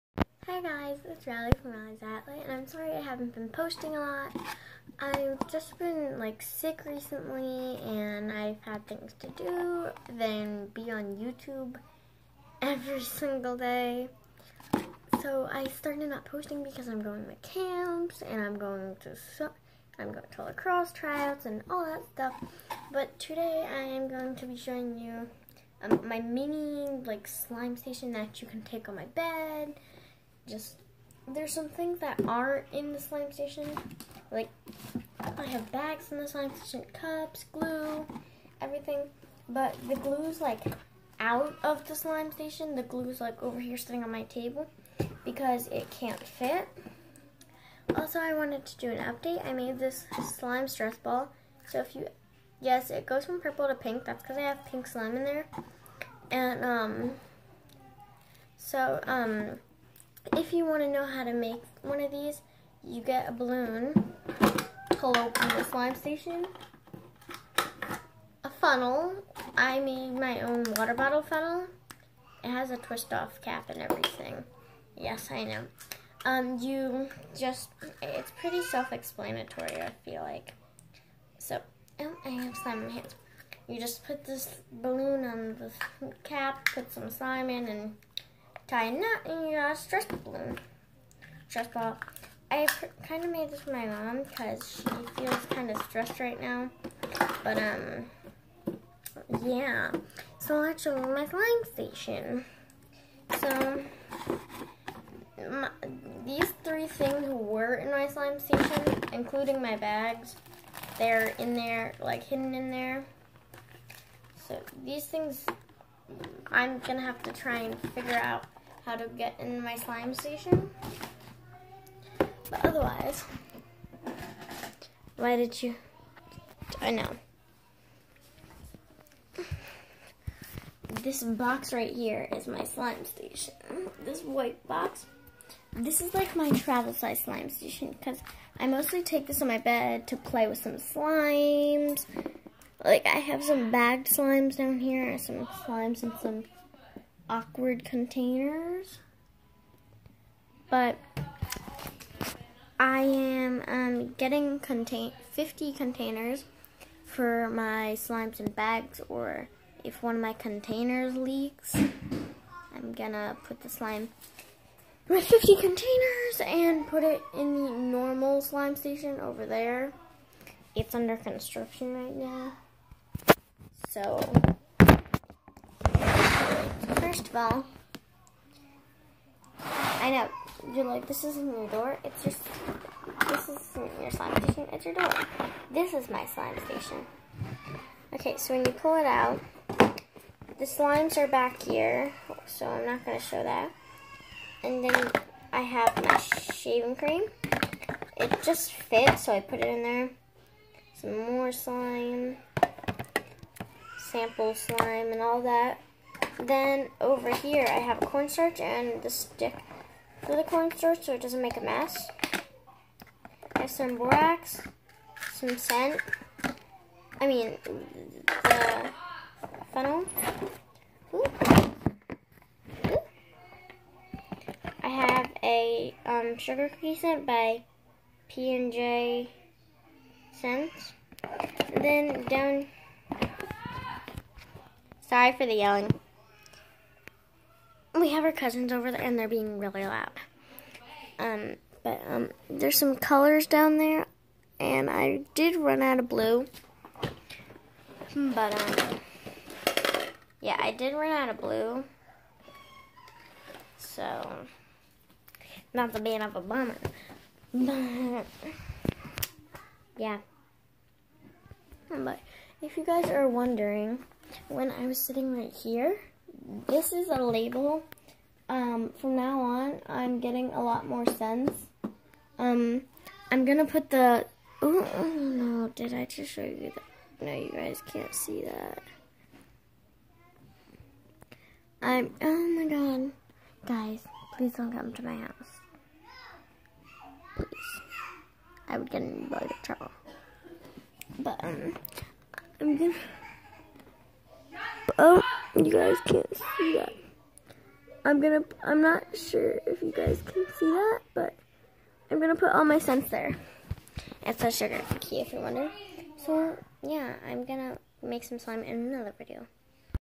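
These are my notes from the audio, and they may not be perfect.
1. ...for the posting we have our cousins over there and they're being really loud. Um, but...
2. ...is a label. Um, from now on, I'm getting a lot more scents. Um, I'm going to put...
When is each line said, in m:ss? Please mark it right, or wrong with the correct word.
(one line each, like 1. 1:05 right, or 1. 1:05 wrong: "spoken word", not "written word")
1. 3:55 wrong: "yelling", not "posting"
2. 4:26 right.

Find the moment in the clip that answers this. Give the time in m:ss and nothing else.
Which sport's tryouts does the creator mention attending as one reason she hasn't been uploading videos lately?
0:20.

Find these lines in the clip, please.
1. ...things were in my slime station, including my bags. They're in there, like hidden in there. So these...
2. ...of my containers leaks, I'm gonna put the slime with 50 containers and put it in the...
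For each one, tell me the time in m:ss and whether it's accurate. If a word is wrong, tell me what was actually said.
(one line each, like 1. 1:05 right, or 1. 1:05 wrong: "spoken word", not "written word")
1. 1:46 right
2. 2:40 right.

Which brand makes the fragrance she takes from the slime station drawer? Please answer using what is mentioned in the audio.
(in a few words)
P&J Scents.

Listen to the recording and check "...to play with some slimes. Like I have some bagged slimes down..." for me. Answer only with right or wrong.
right.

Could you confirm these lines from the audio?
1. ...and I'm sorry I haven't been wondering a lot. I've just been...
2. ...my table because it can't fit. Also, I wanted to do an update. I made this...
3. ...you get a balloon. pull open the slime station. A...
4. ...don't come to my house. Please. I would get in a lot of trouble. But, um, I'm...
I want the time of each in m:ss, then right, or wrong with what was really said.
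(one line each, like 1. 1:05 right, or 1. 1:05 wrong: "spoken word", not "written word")
1. 0:02 wrong: "posting", not "wondering"
2. 0:44 right
3. 1:02 right
4. 4:44 right.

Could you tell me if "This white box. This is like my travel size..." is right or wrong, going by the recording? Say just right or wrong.
right.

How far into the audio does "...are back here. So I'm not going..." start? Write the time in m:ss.
3:11.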